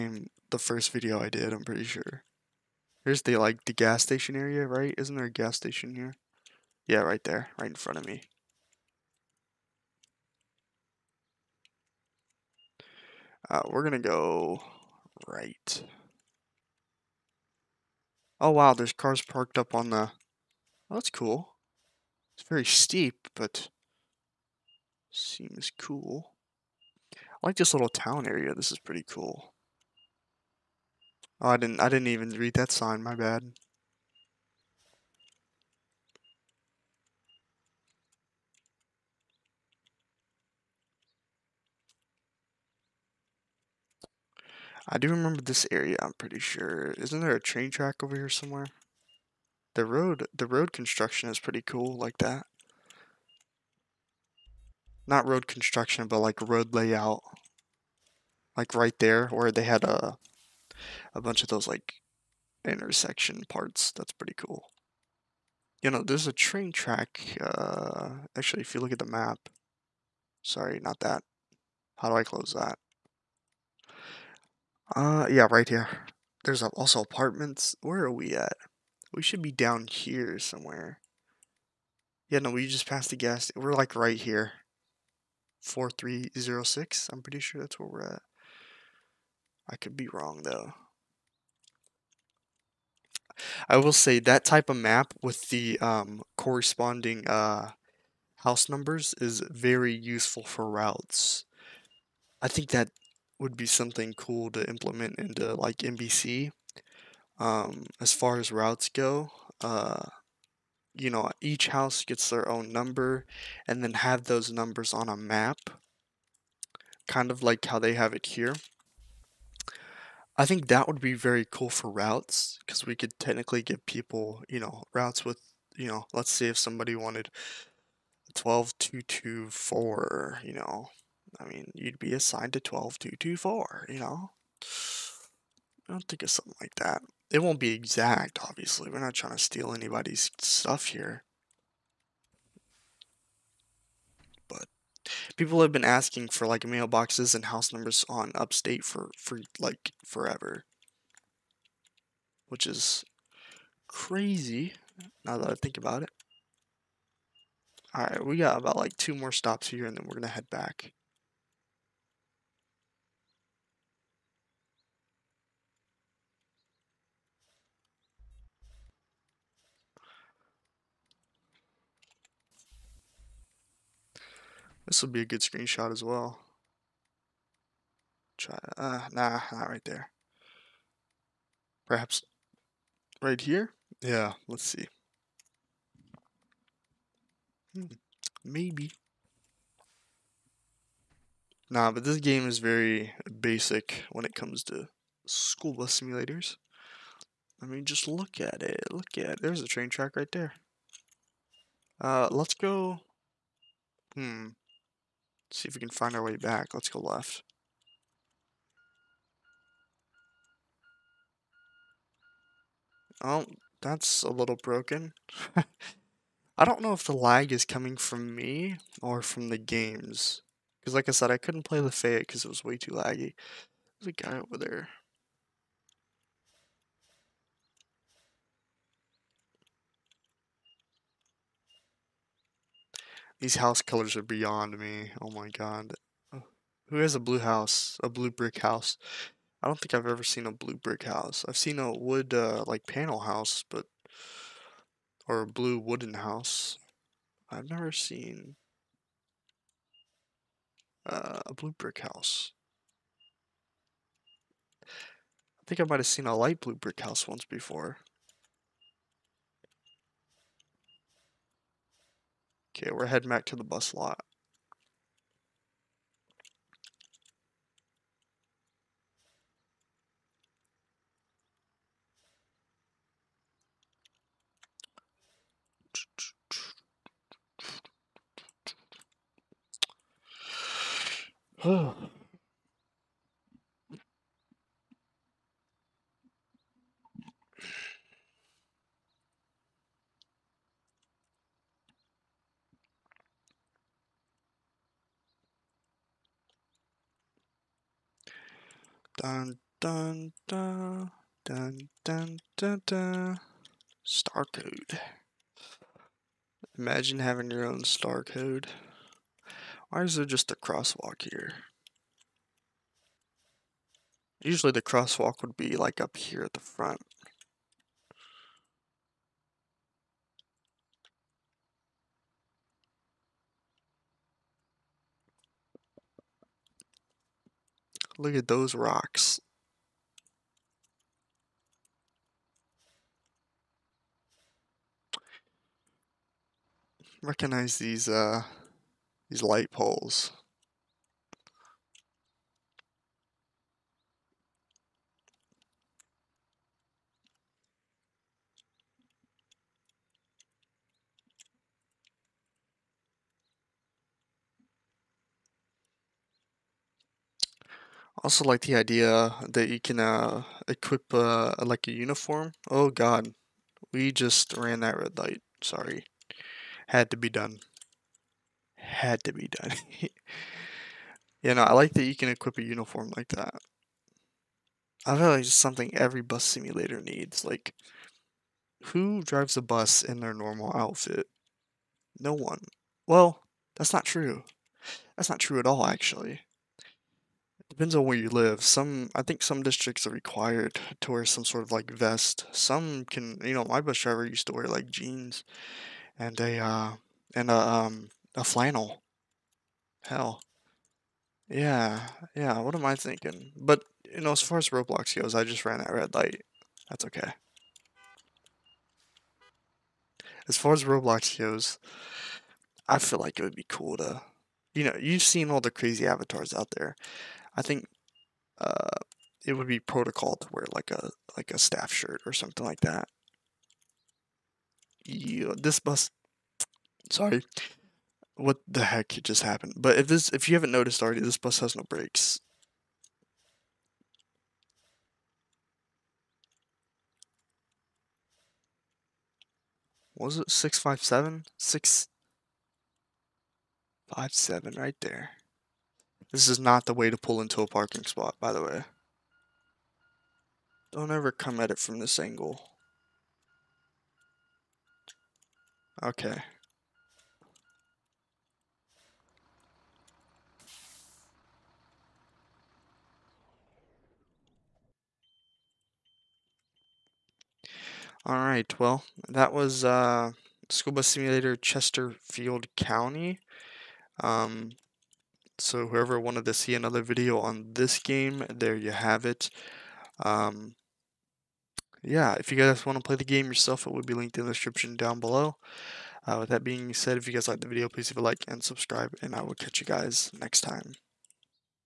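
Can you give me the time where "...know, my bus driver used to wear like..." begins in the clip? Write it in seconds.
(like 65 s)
393 s.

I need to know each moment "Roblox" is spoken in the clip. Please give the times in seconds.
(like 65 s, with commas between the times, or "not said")
404 s, 410 s.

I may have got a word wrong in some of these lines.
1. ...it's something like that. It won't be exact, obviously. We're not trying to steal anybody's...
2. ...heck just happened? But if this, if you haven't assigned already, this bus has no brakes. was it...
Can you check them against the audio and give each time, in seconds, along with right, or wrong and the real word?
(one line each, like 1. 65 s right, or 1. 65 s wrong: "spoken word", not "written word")
1. 136 s right
2. 428 s wrong: "noticed", not "assigned".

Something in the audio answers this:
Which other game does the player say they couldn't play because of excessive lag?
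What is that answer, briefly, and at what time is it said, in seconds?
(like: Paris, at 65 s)
Fate, at 221 s.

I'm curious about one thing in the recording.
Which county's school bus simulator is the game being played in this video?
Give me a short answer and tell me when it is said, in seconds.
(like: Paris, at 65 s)
Chesterfield County, at 471 s.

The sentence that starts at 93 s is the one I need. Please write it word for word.
I will say that type of map with the um, corresponding uh, house numbers is very useful for routes.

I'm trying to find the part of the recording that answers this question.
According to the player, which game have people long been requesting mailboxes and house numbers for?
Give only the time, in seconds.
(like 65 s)
148 s.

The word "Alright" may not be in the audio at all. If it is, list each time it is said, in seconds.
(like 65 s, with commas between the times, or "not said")
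157 s, 468 s.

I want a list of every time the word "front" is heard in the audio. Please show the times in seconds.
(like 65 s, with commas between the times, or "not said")
7 s, 316 s.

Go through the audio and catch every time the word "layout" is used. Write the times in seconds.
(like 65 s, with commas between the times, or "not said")
56 s.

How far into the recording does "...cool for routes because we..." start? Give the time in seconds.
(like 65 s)
121 s.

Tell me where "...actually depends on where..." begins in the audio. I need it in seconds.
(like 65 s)
385 s.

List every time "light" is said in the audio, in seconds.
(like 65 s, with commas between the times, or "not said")
256 s, 339 s, 365 s, 406 s.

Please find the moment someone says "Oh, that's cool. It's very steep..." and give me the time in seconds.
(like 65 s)
20 s.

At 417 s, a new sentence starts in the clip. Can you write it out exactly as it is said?
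I think uh, it would be protocol to wear like a like a staff shirt or something like that.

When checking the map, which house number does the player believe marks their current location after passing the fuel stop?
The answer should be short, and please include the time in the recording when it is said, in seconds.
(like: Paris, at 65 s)
4306, at 85 s.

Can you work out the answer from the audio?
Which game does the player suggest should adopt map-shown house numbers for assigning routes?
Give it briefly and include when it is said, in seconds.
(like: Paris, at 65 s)
NBC, at 105 s.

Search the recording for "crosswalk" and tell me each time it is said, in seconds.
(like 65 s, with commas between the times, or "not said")
310 s, 314 s.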